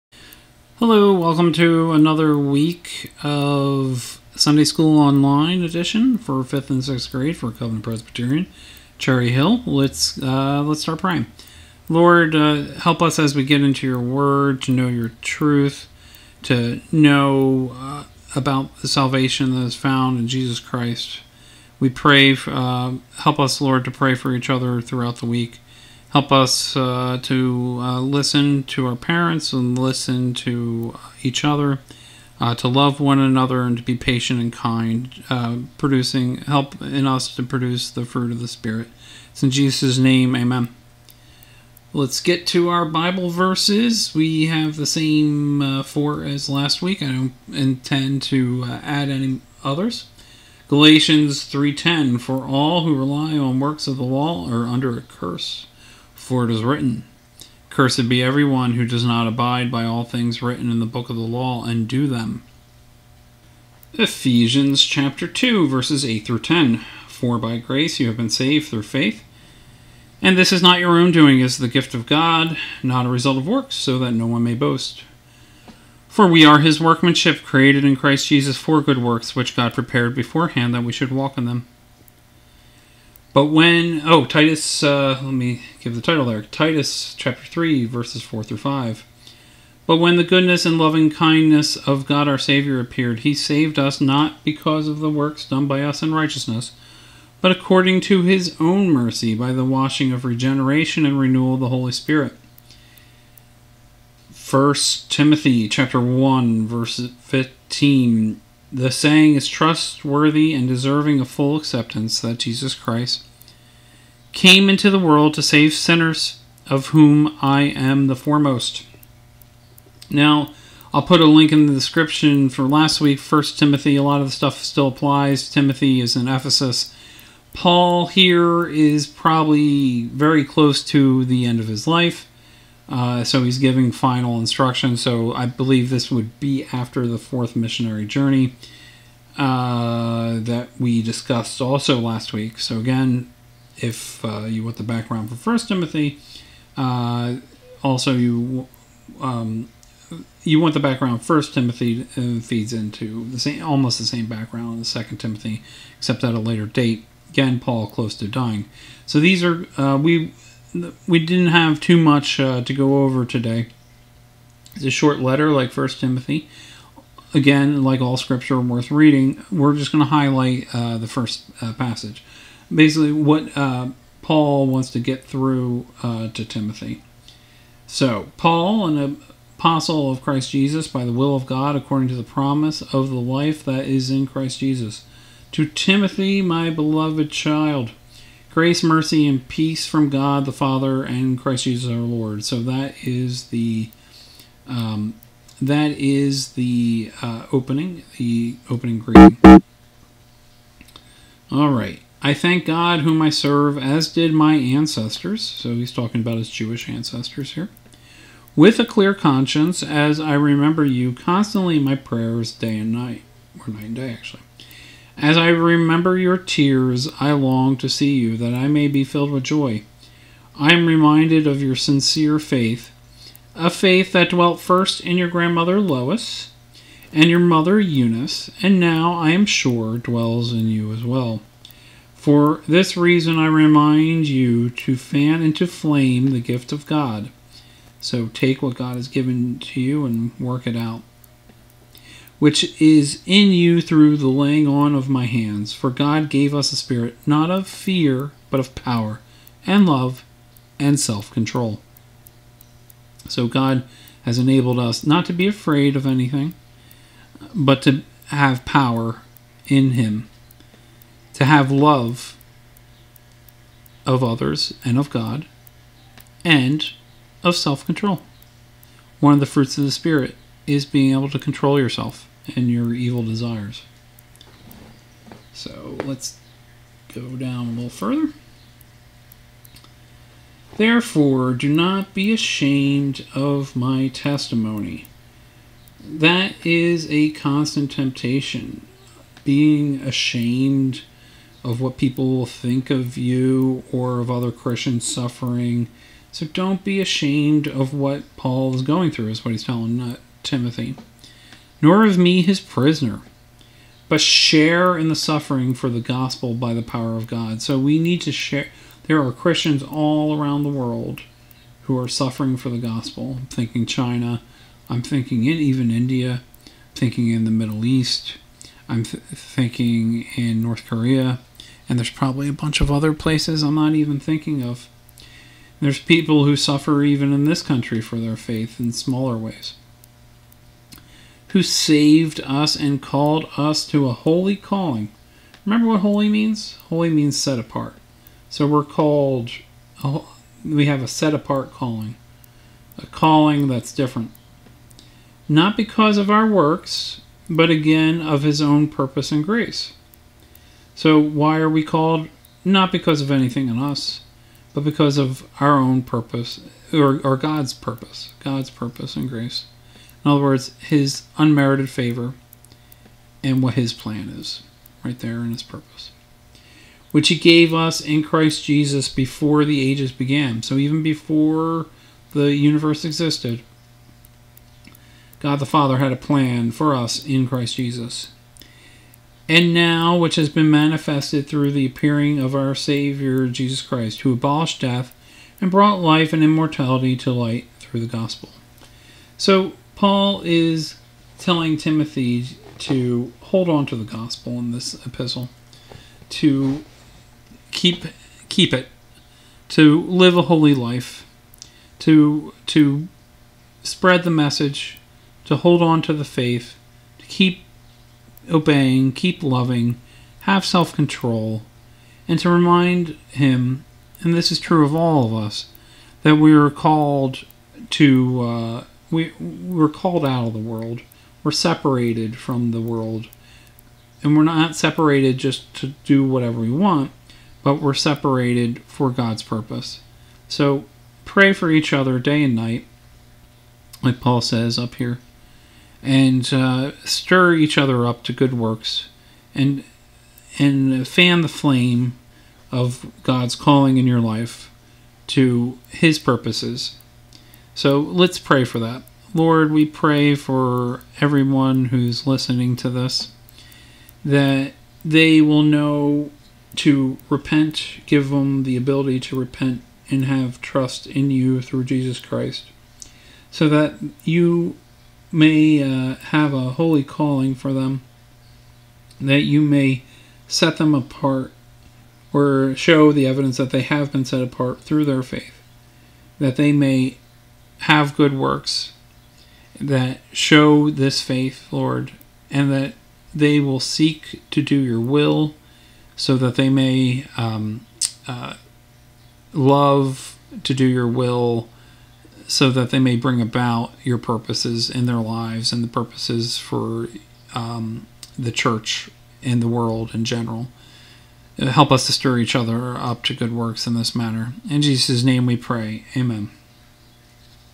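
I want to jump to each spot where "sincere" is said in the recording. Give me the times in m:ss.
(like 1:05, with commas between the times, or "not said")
3:41.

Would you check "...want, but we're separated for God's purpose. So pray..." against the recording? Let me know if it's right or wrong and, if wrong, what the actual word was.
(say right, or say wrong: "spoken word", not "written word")
right.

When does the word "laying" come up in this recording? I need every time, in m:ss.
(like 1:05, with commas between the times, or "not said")
4:04.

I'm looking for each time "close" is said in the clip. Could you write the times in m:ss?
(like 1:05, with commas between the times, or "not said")
2:10, 2:37.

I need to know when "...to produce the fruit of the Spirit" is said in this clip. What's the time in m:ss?
0:37.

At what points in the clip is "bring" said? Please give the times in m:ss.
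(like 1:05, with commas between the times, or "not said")
8:13.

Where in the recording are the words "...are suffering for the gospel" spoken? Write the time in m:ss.
5:11.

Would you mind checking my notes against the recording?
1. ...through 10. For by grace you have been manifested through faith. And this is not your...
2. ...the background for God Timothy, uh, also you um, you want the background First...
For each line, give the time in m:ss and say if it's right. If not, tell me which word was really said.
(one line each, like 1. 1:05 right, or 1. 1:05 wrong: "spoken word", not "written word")
1. 1:06 wrong: "saved", not "manifested"
2. 2:24 wrong: "First", not "God".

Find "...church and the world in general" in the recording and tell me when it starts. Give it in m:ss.
8:18.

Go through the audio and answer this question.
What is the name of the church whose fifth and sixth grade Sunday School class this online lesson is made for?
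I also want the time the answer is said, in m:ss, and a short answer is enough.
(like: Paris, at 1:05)
Covenant Presbyterian, at 0:07.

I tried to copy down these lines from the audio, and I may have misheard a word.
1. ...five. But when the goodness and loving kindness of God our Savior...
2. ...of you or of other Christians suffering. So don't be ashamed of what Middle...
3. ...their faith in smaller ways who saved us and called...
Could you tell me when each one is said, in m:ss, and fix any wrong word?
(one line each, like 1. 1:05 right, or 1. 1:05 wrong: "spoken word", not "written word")
1. 1:28 right
2. 4:52 wrong: "Paul", not "Middle"
3. 5:28 right.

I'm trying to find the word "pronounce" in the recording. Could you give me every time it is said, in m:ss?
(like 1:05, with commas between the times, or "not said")
not said.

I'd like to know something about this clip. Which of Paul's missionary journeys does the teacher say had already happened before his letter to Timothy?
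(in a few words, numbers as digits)
4th.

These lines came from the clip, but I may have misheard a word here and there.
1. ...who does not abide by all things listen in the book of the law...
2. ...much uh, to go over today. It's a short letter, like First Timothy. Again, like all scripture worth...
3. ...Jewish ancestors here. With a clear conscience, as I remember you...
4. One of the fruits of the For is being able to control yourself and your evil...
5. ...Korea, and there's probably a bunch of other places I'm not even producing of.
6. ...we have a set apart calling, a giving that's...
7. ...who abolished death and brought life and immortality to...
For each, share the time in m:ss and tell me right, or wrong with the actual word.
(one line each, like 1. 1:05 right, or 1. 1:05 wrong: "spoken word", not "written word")
1. 0:58 wrong: "written", not "listen"
2. 2:41 right
3. 3:26 right
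4. 4:29 wrong: "Spirit", not "For"
5. 5:20 wrong: "thinking", not "producing"
6. 5:40 wrong: "calling", not "giving"
7. 6:24 right.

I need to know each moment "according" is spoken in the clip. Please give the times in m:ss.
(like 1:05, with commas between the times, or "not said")
1:37, 3:01.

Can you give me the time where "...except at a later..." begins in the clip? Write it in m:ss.
2:35.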